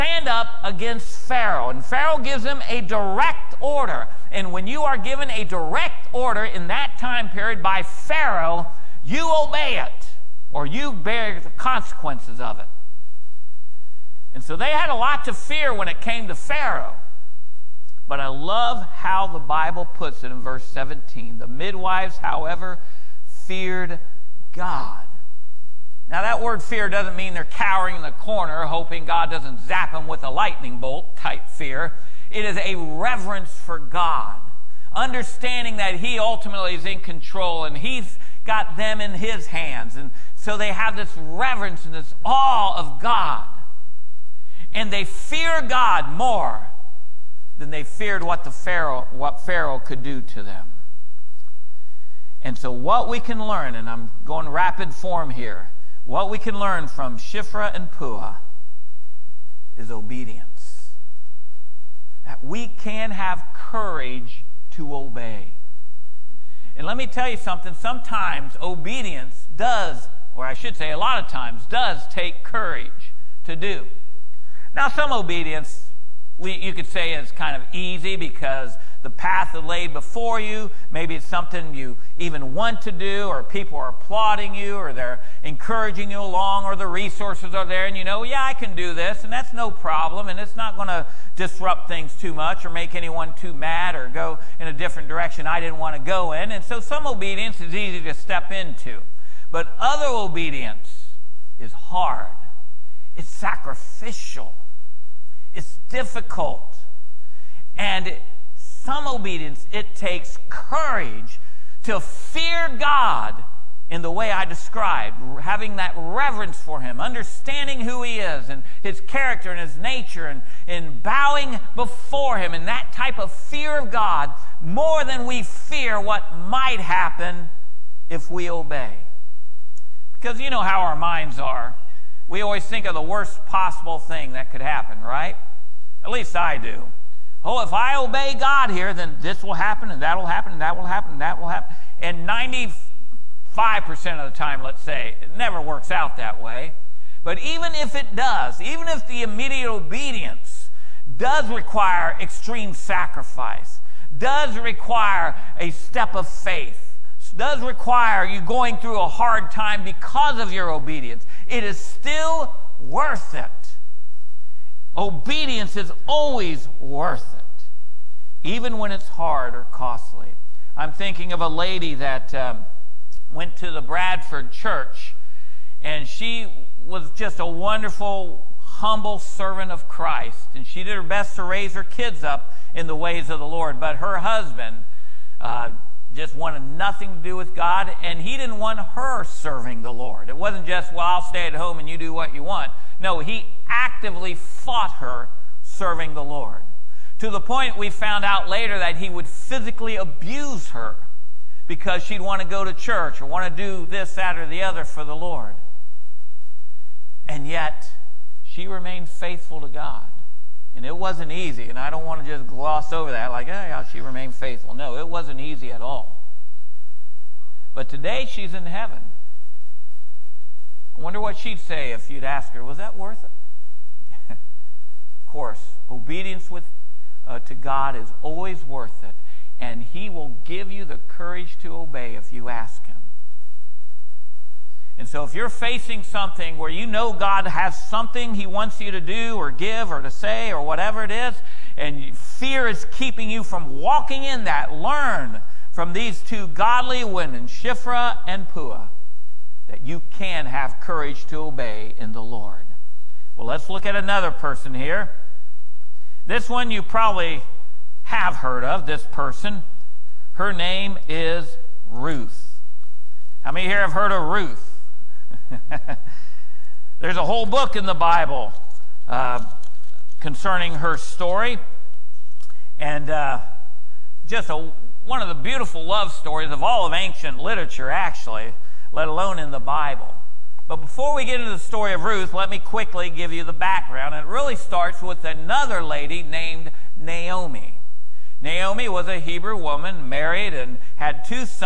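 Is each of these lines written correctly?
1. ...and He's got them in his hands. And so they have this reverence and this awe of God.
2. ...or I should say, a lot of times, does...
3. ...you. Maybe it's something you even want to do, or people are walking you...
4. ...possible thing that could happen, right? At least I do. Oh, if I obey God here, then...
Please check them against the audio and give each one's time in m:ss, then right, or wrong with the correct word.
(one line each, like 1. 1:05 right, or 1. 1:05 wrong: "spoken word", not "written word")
1. 0:37 right
2. 1:10 right
3. 1:20 wrong: "applauding", not "walking"
4. 2:13 right.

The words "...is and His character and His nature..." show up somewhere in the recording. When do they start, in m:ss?
1:58.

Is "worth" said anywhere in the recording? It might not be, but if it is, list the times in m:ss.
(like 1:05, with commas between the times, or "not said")
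2:42, 2:46, 3:42, 3:48.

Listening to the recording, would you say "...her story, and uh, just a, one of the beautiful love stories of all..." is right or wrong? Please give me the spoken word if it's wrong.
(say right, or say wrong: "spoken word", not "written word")
right.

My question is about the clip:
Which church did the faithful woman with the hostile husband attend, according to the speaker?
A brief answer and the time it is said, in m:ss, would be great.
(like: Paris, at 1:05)
Bradford church, at 2:53.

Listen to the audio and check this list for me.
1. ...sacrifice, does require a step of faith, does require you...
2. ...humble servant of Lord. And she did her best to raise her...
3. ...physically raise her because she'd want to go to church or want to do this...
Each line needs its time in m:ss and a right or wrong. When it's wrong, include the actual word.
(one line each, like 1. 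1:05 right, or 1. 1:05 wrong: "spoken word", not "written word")
1. 2:32 right
2. 2:58 wrong: "Christ", not "Lord"
3. 3:19 wrong: "abuse", not "raise".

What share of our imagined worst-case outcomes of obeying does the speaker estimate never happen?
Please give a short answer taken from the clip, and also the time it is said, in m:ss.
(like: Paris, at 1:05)
95%, at 2:22.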